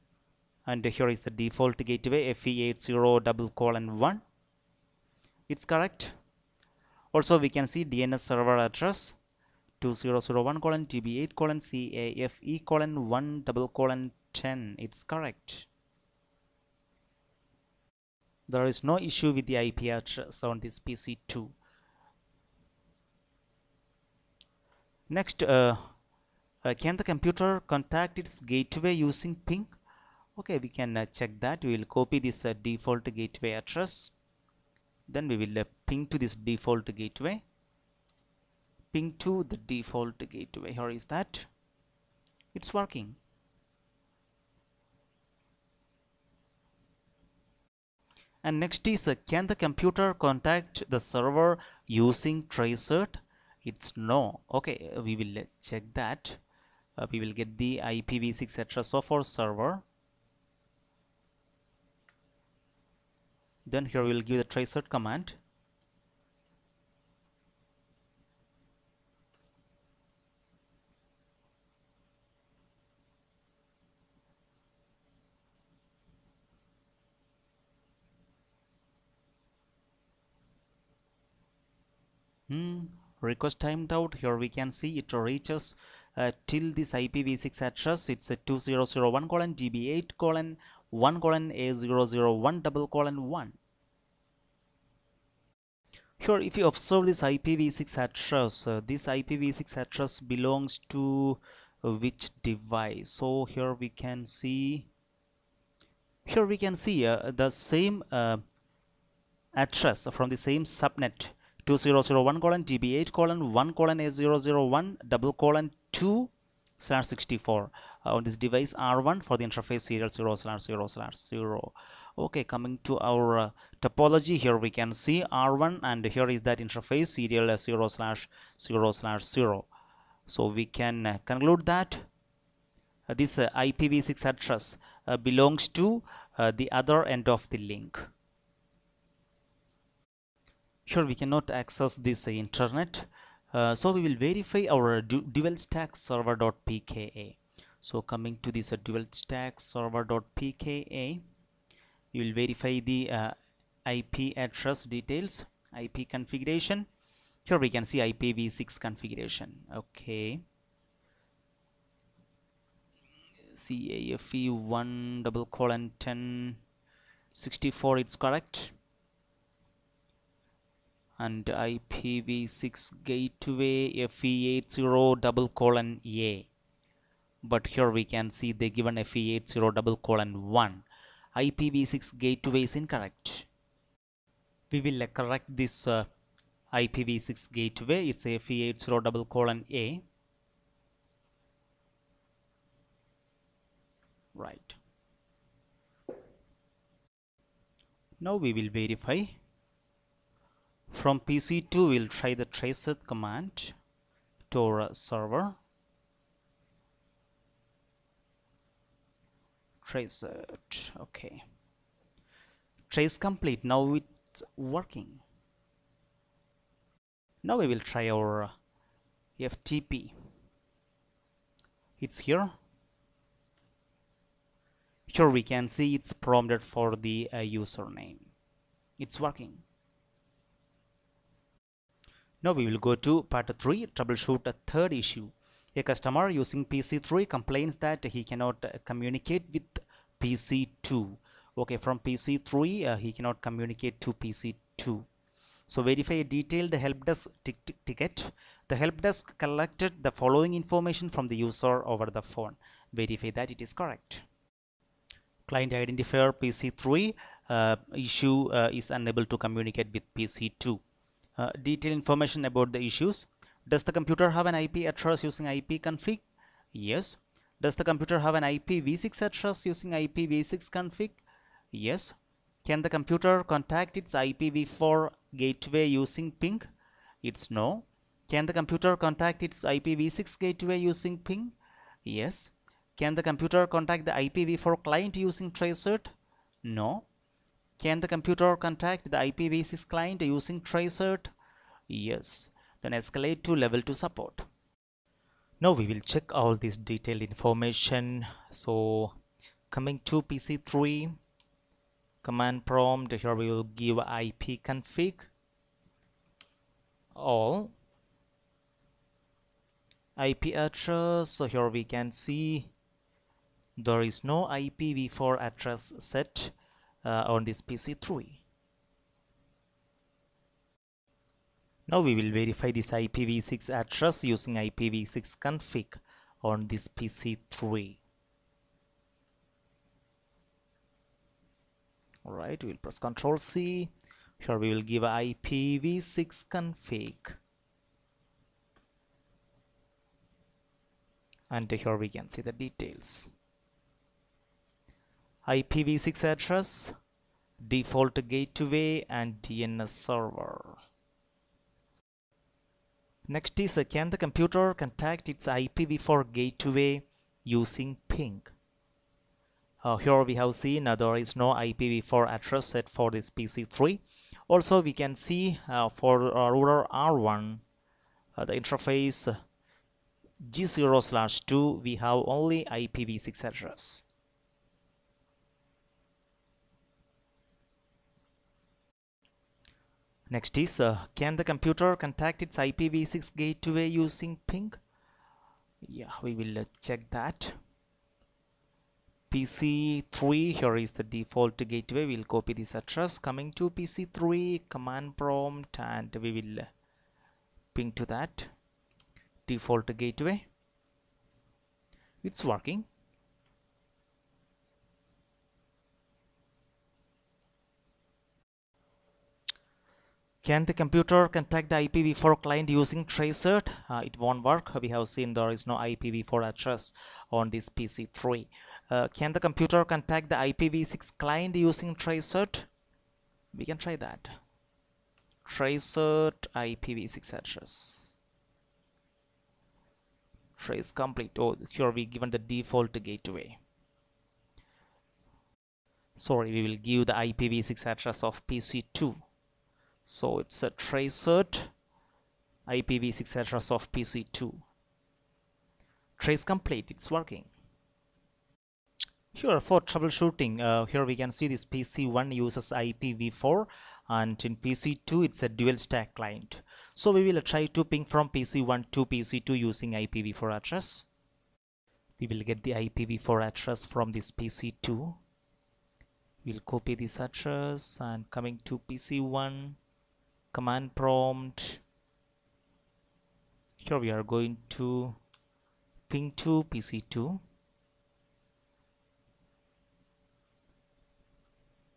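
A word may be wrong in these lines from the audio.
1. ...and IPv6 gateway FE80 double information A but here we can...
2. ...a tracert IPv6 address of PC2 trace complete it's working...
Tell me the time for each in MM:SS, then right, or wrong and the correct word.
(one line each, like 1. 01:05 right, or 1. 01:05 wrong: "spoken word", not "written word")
1. 02:51 wrong: "colon", not "information"
2. 07:20 right.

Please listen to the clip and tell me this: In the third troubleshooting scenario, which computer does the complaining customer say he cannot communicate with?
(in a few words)
PC2.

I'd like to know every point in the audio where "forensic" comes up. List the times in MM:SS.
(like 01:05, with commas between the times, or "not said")
not said.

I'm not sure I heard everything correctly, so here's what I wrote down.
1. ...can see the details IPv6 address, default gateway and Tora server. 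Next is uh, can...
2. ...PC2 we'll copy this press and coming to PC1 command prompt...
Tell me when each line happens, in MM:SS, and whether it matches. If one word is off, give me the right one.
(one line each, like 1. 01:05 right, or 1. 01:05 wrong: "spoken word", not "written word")
1. 05:42 wrong: "DNS", not "Tora"
2. 07:44 wrong: "address", not "press".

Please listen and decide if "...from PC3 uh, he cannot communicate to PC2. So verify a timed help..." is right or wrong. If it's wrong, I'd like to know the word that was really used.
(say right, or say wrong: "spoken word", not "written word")
wrong: "detailed", not "timed".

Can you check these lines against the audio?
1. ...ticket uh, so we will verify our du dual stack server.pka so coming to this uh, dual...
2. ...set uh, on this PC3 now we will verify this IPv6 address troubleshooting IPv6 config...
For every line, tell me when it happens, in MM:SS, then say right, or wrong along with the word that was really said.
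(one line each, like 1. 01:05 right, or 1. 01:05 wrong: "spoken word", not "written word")
1. 02:22 wrong: "internet", not "ticket"
2. 05:15 wrong: "using", not "troubleshooting".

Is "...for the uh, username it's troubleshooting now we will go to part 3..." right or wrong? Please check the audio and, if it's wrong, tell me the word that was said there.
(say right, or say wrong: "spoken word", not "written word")
wrong: "working", not "troubleshooting".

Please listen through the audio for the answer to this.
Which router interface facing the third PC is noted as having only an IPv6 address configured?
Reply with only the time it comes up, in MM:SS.
06:10.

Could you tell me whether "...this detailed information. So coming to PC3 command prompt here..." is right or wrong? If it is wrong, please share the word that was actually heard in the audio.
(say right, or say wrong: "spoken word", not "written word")
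right.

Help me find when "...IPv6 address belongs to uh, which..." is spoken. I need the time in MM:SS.
01:39.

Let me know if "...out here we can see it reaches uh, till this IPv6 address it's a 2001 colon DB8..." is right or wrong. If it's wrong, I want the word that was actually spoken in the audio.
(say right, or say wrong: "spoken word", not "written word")
right.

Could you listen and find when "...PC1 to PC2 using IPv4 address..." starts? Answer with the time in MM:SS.
07:38.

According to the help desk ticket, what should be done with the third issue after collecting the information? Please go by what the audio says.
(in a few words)
escalate to level 2 support.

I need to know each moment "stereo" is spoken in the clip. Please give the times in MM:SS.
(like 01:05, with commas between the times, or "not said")
not said.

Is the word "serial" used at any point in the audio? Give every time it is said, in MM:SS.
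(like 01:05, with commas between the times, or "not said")
01:59, 02:07.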